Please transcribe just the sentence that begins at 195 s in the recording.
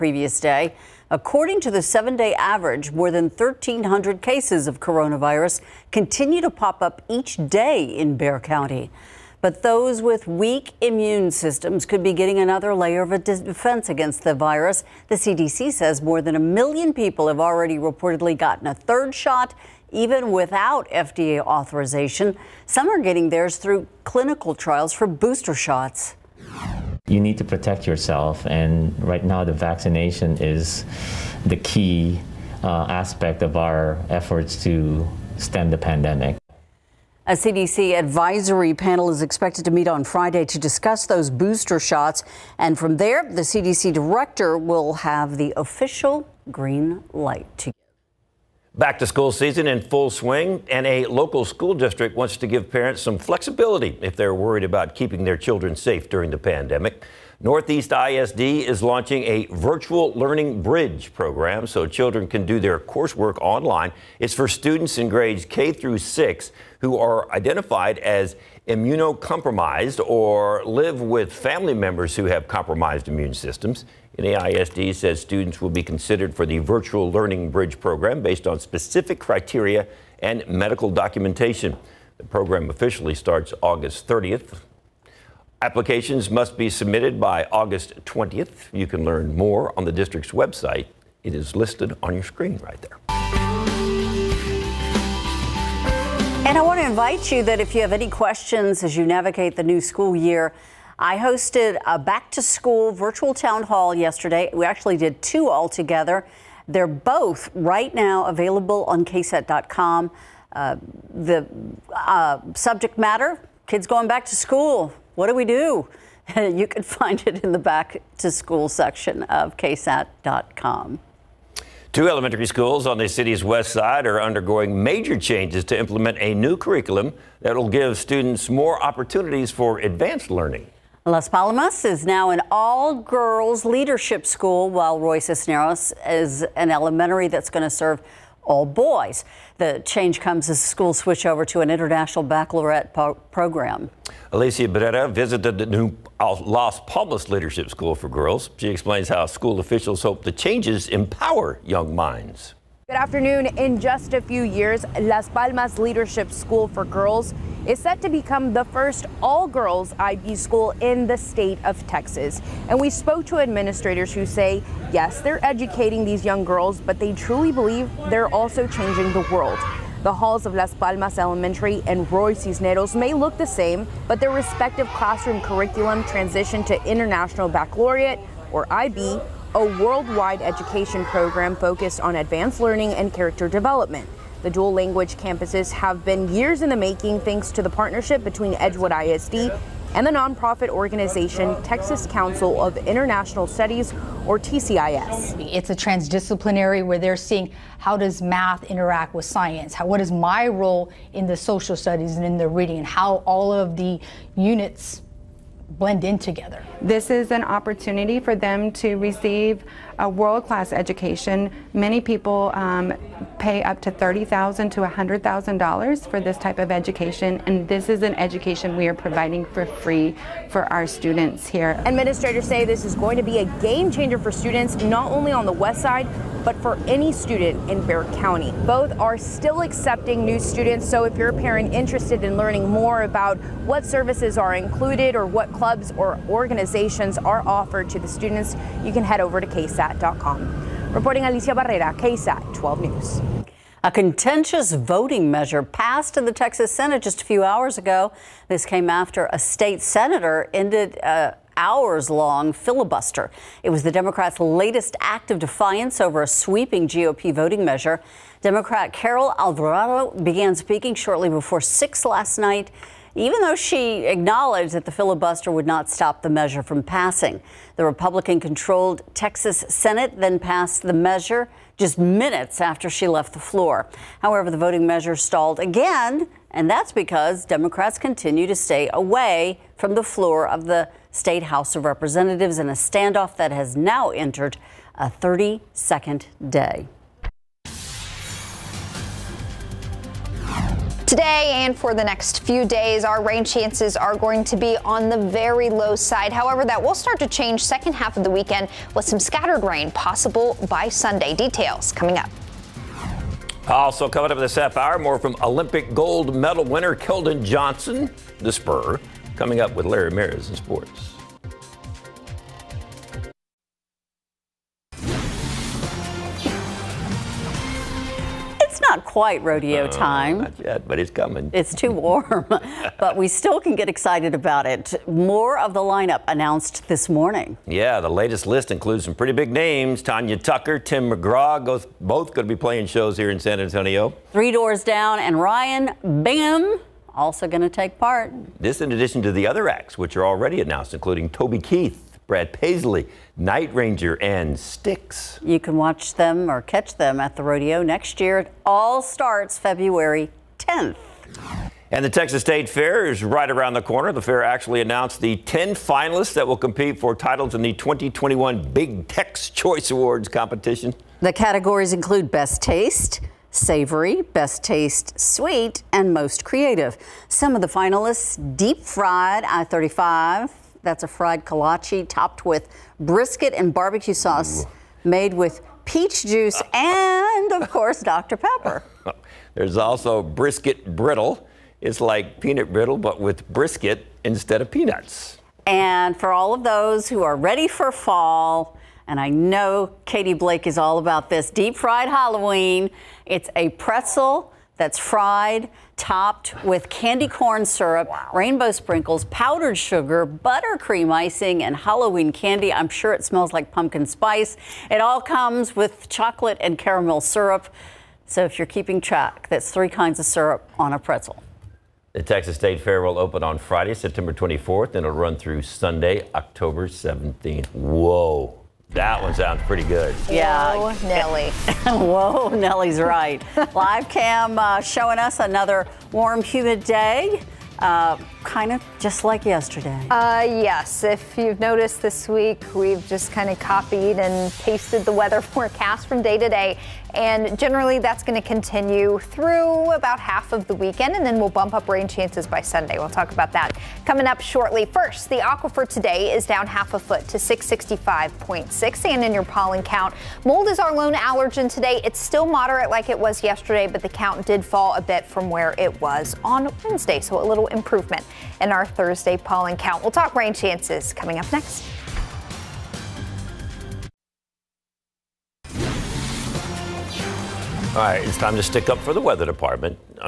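It's a transdisciplinary where they're seeing how does math interact with science?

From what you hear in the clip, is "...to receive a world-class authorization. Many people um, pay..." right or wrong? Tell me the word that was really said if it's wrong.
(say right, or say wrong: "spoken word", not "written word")
wrong: "education", not "authorization".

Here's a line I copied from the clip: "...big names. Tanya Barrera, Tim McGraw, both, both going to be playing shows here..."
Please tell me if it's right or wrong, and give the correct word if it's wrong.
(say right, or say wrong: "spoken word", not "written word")
wrong: "Tucker", not "Barrera".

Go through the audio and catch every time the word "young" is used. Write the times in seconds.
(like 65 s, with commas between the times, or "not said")
151 s, 166 s.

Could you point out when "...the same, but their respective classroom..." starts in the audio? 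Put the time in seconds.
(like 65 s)
173 s.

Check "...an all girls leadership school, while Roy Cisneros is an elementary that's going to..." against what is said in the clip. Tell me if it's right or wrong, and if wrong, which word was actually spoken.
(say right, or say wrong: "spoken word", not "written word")
right.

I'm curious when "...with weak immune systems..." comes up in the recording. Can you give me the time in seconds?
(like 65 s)
10 s.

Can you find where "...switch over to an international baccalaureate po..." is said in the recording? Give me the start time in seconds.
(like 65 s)
140 s.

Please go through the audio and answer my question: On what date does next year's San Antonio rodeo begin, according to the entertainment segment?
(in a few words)
February 10th.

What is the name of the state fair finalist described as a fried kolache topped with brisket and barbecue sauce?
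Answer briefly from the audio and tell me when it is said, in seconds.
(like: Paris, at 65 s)
deep fried I 35, at 368 s.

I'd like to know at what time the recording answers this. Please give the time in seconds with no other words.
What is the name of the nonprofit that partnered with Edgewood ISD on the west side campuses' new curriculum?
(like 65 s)
191 s.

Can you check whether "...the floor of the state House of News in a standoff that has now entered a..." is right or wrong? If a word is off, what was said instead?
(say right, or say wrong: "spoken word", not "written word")
wrong: "Representatives", not "News".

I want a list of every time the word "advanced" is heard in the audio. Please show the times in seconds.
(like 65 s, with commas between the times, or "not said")
129 s, 182 s.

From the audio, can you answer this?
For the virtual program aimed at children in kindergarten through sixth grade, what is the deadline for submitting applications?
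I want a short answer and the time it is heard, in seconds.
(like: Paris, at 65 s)
August 20th, at 87 s.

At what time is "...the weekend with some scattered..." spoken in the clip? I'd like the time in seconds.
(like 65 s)
298 s.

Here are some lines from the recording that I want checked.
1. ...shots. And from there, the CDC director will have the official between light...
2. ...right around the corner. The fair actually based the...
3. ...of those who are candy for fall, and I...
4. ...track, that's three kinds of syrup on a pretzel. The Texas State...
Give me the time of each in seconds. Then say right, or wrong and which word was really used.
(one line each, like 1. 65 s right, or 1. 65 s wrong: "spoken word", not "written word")
1. 41 s wrong: "green", not "between"
2. 353 s wrong: "announced", not "based"
3. 386 s wrong: "ready", not "candy"
4. 408 s right.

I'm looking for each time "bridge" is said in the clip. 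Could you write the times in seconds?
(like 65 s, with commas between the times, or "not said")
60 s, 77 s.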